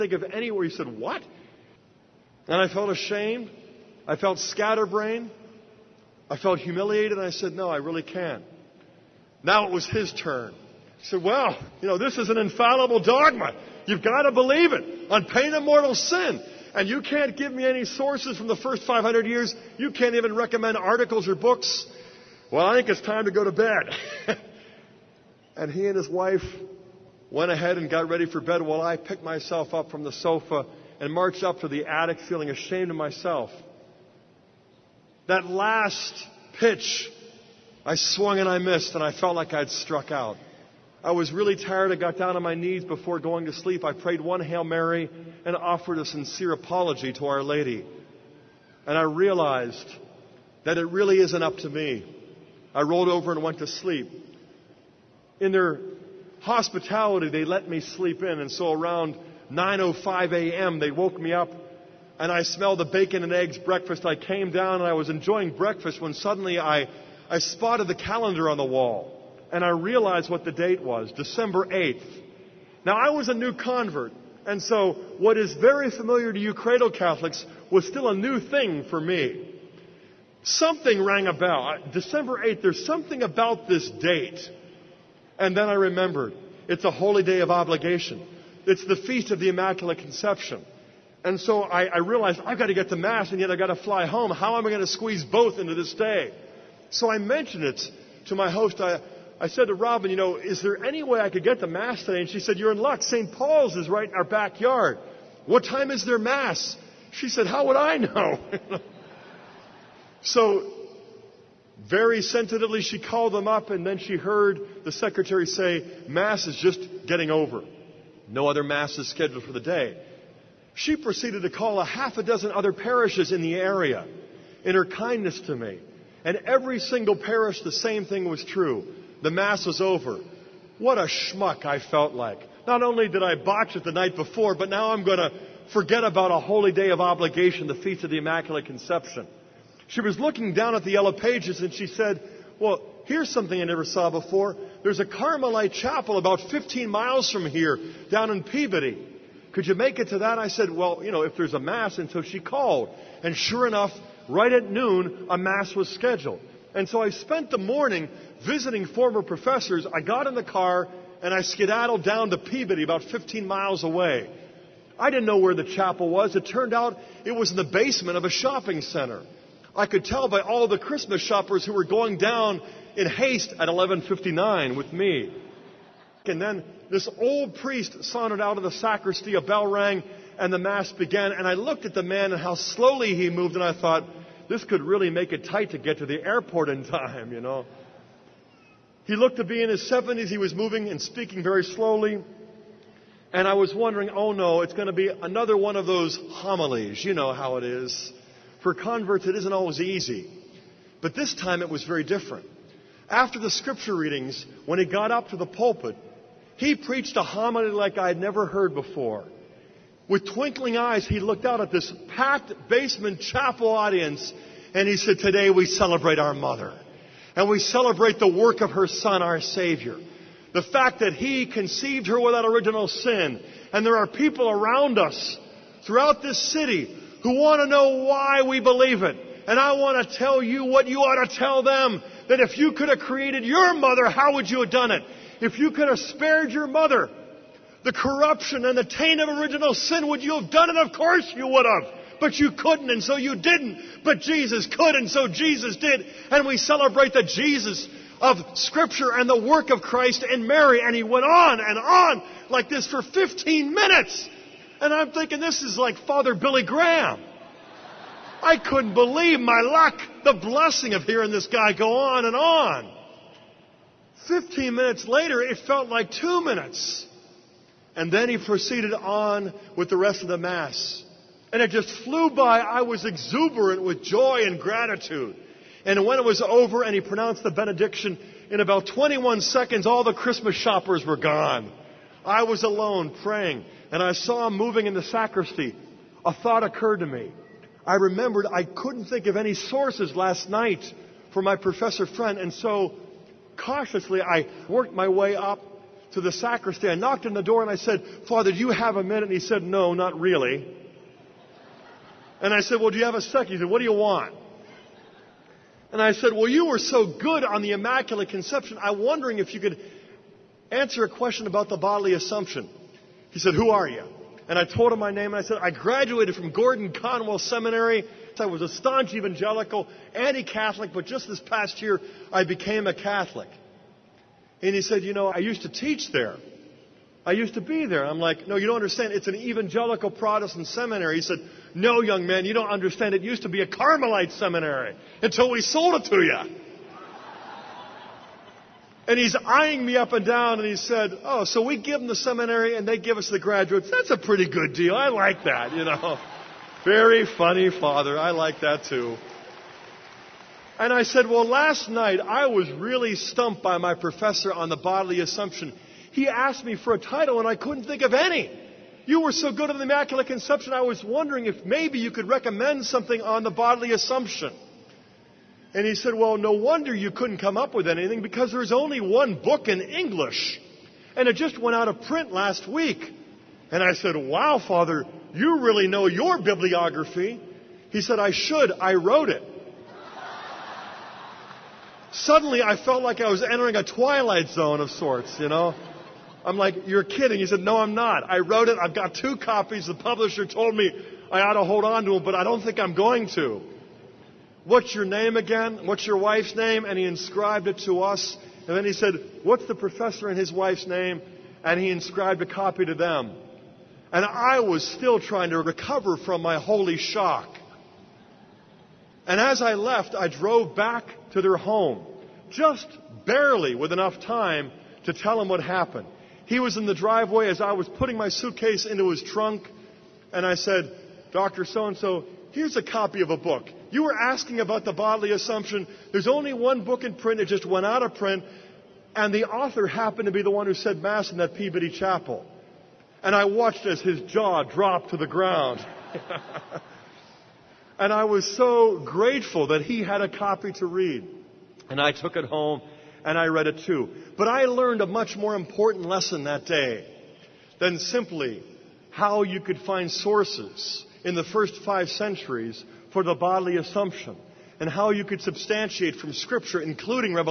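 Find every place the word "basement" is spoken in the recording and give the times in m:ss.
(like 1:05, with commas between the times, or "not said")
2:47, 3:32.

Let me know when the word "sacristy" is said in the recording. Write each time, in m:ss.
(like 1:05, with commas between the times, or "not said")
2:58, 4:45, 4:56.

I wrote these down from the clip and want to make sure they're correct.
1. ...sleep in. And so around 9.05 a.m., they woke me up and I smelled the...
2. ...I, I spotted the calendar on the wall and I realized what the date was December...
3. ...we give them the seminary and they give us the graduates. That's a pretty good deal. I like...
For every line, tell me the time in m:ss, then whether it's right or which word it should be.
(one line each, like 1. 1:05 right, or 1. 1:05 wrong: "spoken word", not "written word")
1. 0:57 right
2. 1:06 right
3. 5:41 right.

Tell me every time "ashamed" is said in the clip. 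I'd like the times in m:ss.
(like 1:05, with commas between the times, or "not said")
0:02, 0:32.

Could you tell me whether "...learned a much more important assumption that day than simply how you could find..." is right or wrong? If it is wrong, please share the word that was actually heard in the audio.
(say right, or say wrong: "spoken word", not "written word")
wrong: "lesson", not "assumption".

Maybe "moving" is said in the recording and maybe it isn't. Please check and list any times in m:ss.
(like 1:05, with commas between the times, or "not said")
3:10, 4:44.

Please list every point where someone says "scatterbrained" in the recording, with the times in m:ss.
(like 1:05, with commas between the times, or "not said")
0:04.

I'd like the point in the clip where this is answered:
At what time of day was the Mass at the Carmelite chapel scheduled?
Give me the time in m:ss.
2:34.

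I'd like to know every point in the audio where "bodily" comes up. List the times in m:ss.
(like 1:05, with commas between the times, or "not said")
5:11, 5:54, 6:03, 7:04, 7:33.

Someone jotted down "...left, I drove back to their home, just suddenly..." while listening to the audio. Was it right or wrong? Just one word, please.
wrong.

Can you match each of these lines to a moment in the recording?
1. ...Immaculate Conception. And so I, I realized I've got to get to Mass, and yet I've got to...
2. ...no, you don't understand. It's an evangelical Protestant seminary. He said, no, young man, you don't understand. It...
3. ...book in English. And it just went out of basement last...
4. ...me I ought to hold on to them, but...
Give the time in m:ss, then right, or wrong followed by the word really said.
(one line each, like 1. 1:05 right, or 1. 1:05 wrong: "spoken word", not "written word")
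1. 1:29 right
2. 5:28 right
3. 6:09 wrong: "print", not "basement"
4. 6:30 right.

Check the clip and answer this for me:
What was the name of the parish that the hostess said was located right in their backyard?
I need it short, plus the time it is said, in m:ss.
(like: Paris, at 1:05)
St. Paul's, at 1:43.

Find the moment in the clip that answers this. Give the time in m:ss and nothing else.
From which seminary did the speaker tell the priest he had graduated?
5:16.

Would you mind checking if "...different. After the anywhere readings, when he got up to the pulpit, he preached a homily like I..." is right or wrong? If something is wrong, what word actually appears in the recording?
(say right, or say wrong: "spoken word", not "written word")
wrong: "scripture", not "anywhere".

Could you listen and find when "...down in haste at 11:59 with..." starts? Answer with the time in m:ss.
2:52.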